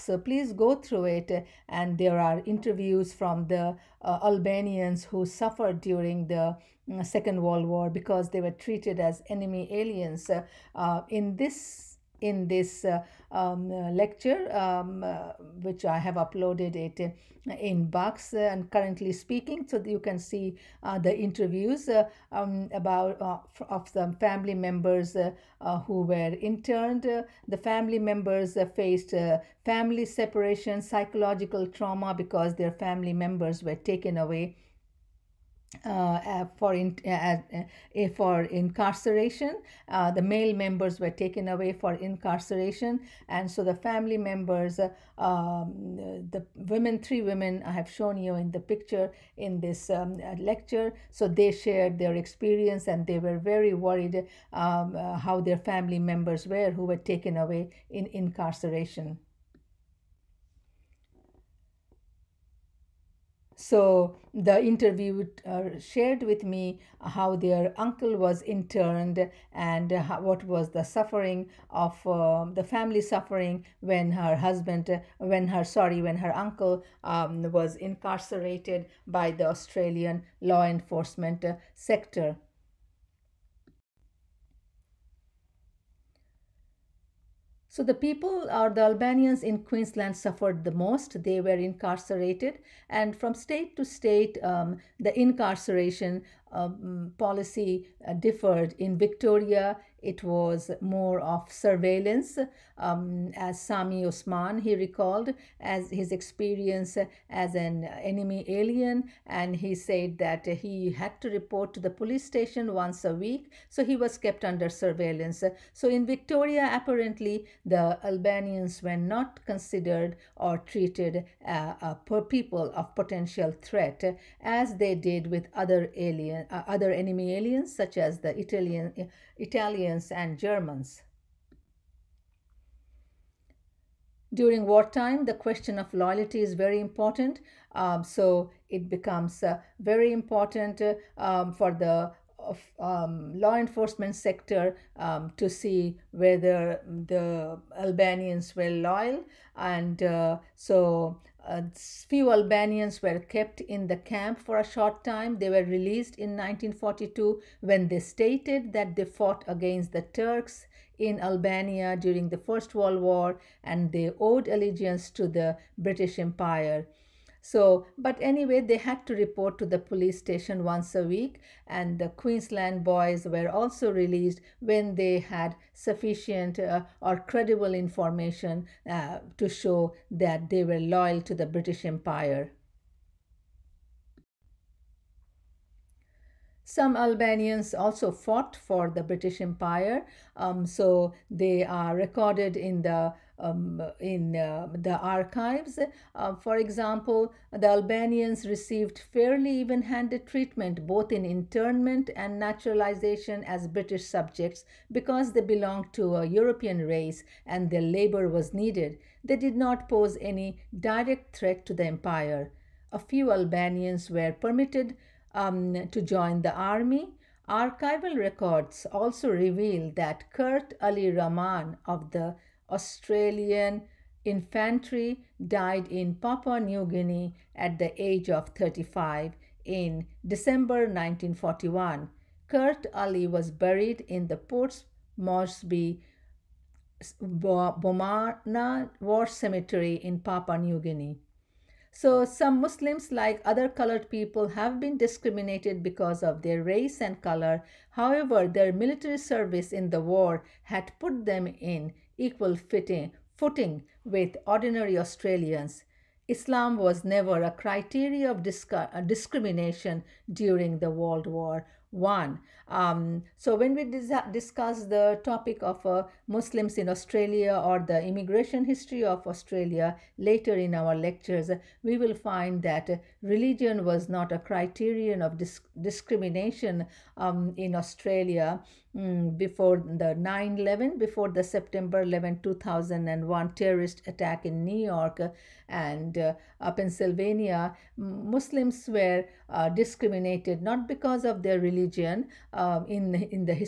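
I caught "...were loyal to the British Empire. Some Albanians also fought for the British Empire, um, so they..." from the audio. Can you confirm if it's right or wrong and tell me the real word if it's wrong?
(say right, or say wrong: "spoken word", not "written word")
right.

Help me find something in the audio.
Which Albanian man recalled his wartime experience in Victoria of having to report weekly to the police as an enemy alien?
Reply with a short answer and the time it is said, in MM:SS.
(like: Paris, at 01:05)
Sami Osman, at 01:43.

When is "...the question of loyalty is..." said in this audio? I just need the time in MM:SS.
02:15.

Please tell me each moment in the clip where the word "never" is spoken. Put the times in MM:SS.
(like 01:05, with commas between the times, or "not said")
04:17.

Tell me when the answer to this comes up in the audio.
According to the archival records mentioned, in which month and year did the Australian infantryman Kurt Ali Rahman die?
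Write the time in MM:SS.
03:50.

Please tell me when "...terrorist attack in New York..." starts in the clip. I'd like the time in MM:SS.
04:43.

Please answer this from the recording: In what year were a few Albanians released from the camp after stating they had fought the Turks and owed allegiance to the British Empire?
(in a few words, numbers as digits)
1942.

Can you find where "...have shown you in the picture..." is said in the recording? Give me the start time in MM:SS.
00:47.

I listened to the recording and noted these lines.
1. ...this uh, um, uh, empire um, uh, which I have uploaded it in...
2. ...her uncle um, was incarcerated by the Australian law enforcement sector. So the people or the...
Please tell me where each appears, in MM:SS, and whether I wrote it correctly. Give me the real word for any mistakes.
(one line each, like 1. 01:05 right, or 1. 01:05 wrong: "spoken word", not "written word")
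1. 00:12 wrong: "lecture", not "empire"
2. 01:16 right.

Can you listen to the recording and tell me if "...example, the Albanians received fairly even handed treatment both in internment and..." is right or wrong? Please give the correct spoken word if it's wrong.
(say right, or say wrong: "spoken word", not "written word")
right.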